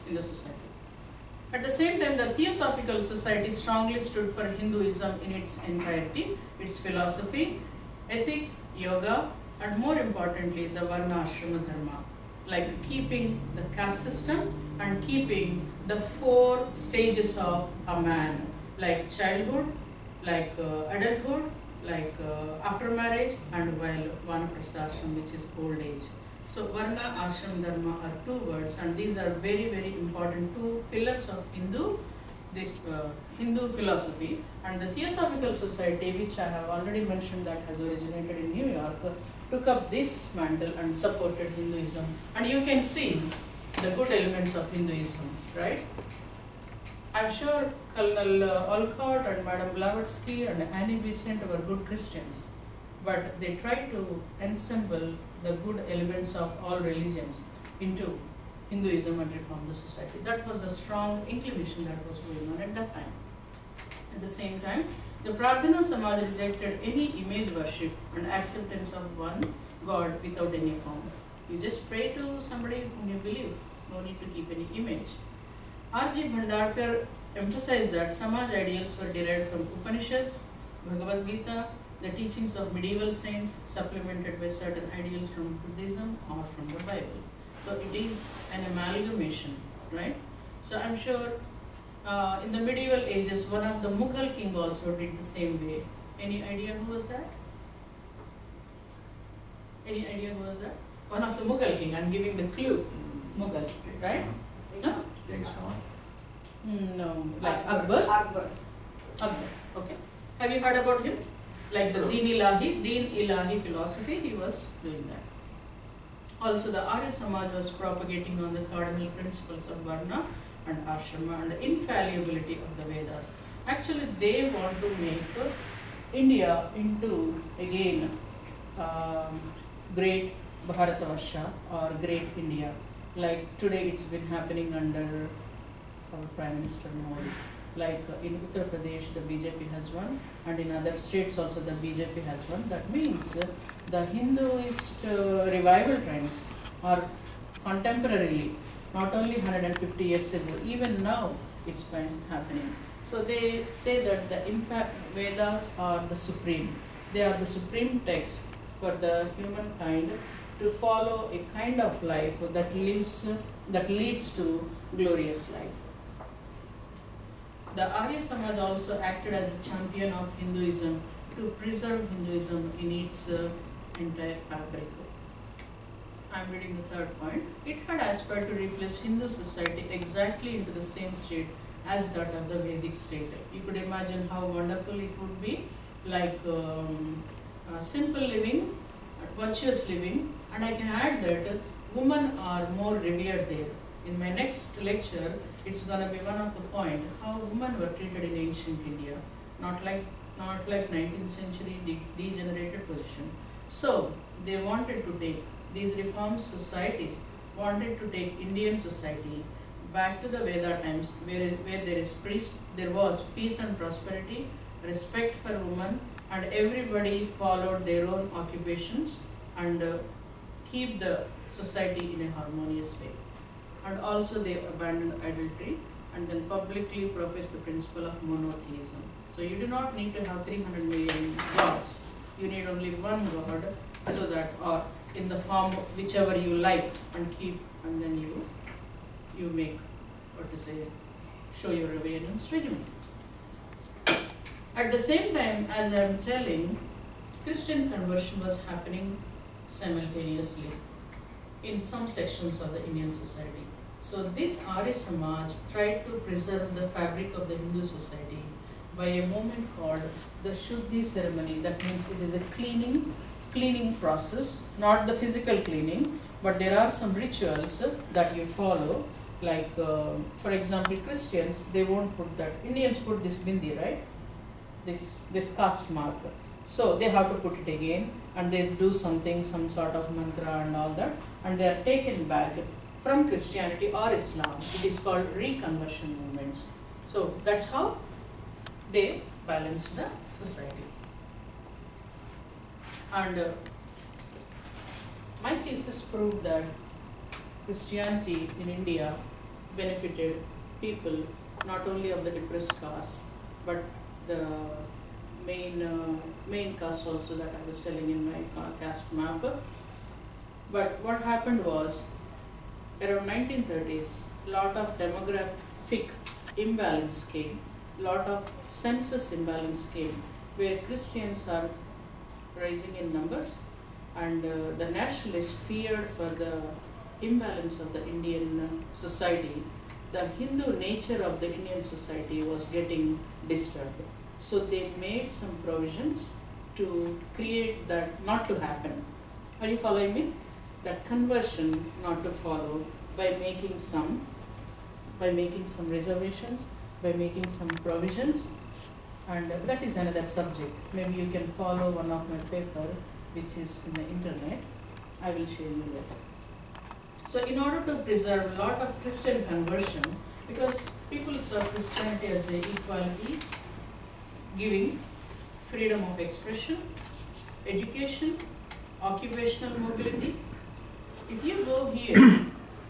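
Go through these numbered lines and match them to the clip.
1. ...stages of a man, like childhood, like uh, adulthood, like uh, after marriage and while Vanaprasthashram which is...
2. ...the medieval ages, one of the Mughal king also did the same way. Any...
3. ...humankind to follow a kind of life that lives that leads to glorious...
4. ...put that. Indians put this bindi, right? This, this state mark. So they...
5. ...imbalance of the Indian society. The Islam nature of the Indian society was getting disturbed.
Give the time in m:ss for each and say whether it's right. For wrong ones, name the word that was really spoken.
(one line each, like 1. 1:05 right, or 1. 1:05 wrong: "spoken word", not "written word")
1. 0:16 right
2. 1:32 right
3. 2:39 right
4. 4:32 wrong: "caste", not "state"
5. 5:27 wrong: "Hindu", not "Islam".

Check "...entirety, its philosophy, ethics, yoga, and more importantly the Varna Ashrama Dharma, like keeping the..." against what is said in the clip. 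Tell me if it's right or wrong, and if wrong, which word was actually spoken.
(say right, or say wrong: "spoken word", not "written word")
right.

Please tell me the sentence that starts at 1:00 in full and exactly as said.
That was the strong inclination that was going on at that time.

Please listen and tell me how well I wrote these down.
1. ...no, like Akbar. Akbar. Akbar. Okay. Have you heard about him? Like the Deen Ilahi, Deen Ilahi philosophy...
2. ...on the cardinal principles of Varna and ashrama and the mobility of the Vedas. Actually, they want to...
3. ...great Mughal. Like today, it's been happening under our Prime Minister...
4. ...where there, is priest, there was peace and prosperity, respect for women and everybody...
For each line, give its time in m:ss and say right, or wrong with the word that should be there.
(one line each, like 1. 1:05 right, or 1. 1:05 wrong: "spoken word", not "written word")
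1. 1:46 right
2. 1:58 wrong: "infallibility", not "mobility"
3. 2:12 wrong: "India", not "Mughal"
4. 3:31 right.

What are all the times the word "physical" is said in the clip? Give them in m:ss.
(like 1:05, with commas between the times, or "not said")
4:25.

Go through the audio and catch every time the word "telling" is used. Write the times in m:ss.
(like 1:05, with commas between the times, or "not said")
4:06, 5:07.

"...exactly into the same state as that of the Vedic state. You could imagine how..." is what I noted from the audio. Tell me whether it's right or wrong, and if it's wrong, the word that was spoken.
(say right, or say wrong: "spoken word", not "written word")
right.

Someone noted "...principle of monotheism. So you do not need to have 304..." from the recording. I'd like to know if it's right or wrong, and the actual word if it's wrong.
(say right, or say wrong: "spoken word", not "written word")
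wrong: "300", not "304".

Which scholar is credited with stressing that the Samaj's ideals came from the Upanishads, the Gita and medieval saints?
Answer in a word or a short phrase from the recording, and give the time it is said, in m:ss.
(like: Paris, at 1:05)
R.G. Bhandarkar, at 1:15.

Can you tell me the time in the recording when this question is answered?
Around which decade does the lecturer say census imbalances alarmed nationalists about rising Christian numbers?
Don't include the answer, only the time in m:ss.
5:13.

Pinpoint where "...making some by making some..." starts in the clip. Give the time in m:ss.
5:43.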